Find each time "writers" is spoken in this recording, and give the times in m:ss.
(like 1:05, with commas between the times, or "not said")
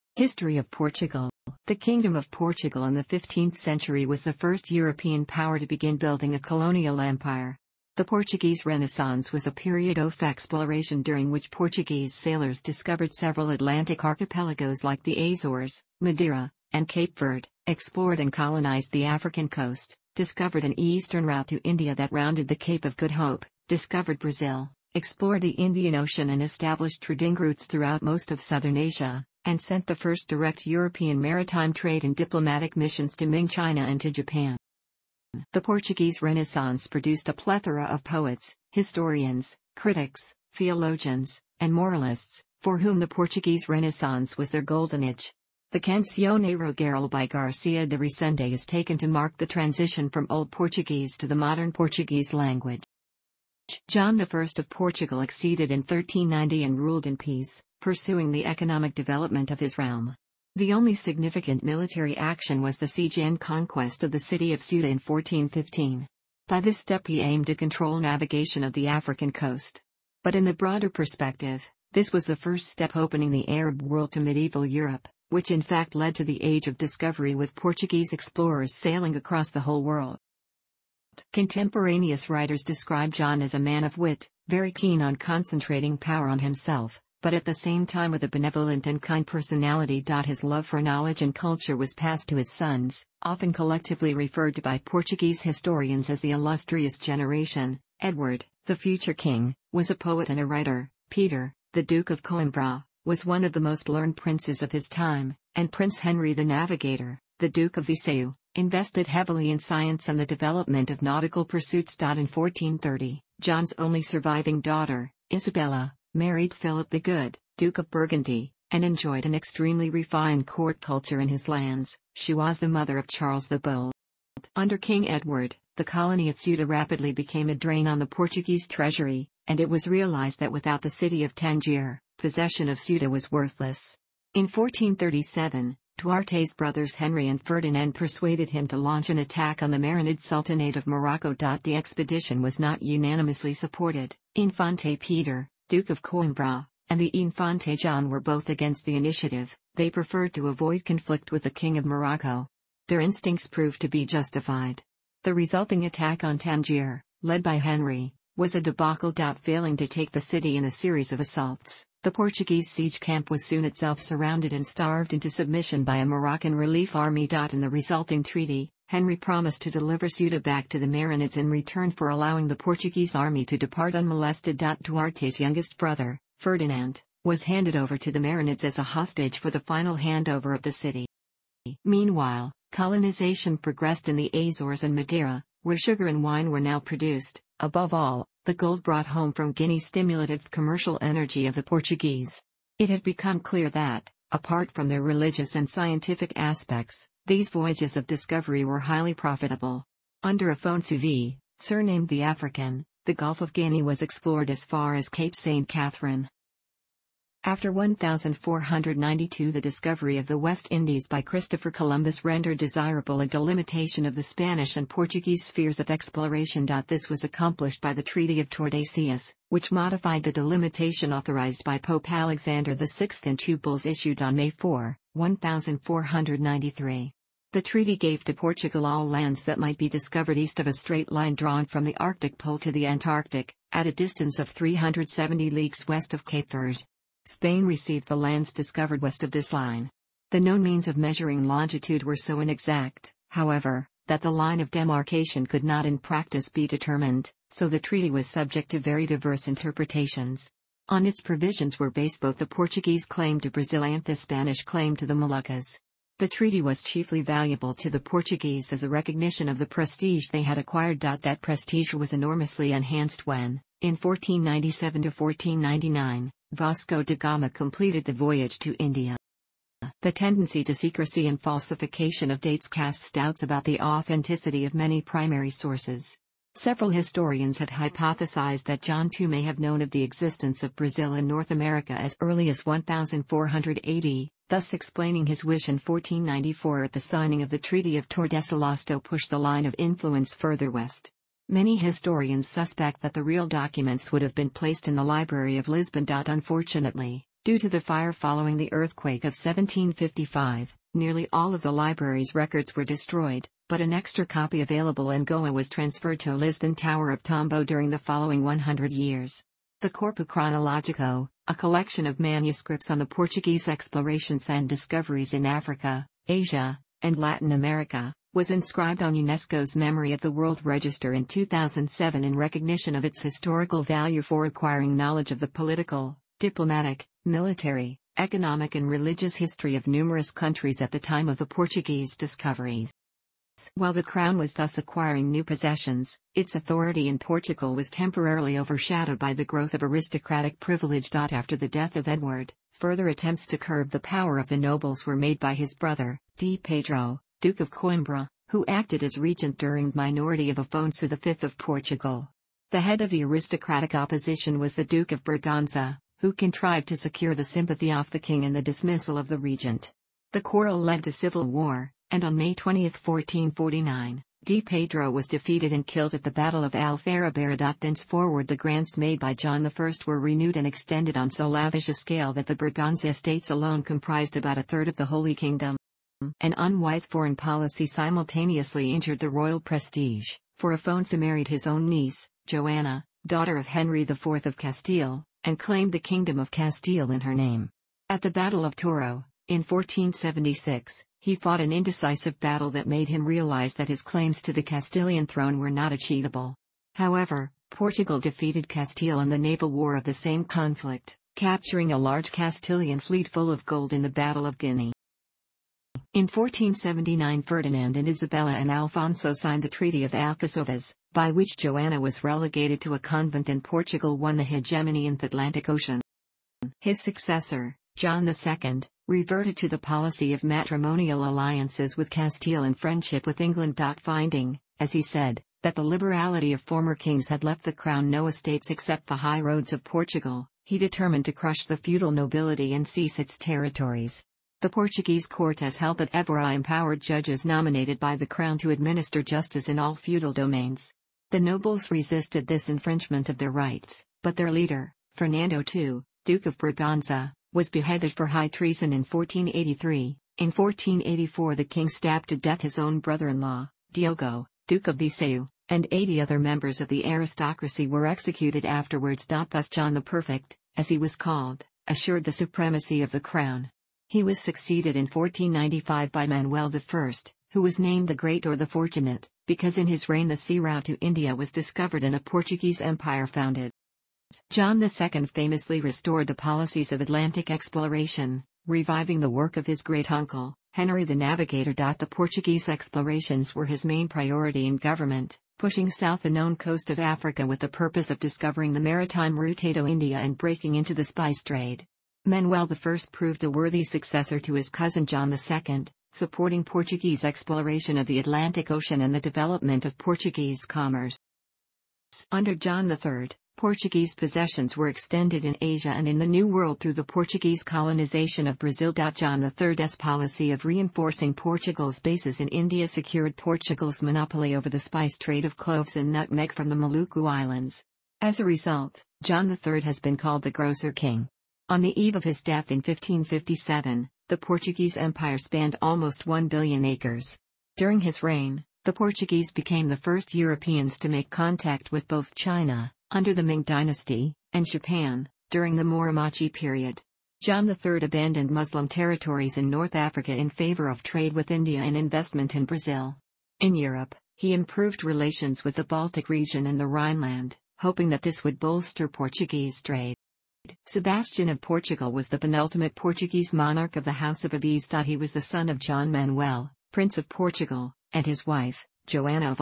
1:22, 1:40.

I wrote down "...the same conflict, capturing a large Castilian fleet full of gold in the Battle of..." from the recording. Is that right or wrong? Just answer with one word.
right.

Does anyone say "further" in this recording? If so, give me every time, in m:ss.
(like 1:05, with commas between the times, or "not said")
4:50, 5:42.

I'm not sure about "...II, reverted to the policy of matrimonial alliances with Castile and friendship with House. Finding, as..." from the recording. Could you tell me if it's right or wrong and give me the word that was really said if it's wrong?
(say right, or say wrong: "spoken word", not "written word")
wrong: "England", not "House".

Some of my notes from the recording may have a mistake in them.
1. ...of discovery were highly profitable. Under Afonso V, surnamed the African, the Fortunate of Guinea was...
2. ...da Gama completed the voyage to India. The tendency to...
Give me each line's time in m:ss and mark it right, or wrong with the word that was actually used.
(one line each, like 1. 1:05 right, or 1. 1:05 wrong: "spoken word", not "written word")
1. 3:17 wrong: "Gulf", not "Fortunate"
2. 4:27 right.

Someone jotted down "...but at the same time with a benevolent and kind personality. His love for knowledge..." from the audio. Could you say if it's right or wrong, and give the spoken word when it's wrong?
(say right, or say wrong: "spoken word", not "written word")
right.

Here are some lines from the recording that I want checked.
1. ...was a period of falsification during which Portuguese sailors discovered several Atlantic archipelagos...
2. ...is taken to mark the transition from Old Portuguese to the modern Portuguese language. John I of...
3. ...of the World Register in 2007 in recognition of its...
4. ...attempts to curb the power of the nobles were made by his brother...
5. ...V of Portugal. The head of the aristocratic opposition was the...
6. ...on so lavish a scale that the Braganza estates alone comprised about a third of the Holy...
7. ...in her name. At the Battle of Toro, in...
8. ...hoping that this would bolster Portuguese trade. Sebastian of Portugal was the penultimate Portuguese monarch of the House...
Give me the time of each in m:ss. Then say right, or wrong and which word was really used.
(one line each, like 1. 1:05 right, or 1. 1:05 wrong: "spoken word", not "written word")
1. 0:09 wrong: "exploration", not "falsification"
2. 0:48 right
3. 5:20 right
4. 5:43 right
5. 5:51 right
6. 6:11 right
7. 6:27 right
8. 9:07 right.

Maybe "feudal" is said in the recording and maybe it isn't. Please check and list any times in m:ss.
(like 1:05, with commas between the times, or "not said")
7:11, 7:19.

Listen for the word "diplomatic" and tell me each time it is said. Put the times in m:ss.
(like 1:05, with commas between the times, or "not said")
0:32, 5:26.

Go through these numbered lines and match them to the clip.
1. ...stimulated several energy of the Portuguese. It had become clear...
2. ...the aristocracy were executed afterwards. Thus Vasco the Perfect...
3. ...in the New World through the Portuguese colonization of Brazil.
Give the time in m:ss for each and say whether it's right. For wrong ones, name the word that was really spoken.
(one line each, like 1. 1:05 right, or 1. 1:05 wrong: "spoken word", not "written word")
1. 3:09 wrong: "commercial", not "several"
2. 7:36 wrong: "John", not "Vasco"
3. 8:26 right.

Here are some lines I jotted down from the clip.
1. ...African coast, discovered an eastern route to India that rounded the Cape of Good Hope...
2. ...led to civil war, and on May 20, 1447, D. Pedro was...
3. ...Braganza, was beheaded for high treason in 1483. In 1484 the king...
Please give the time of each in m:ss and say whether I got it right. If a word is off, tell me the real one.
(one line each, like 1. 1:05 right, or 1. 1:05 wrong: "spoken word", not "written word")
1. 0:19 right
2. 6:00 wrong: "1449", not "1447"
3. 7:26 right.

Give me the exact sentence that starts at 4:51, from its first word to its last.
Many historians suspect that the real documents would have been placed in the Library of Lisbon.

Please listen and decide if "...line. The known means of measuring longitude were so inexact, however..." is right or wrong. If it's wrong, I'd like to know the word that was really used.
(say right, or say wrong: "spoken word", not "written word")
right.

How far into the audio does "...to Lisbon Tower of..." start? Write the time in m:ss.
5:06.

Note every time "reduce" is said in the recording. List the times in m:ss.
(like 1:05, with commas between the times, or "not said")
not said.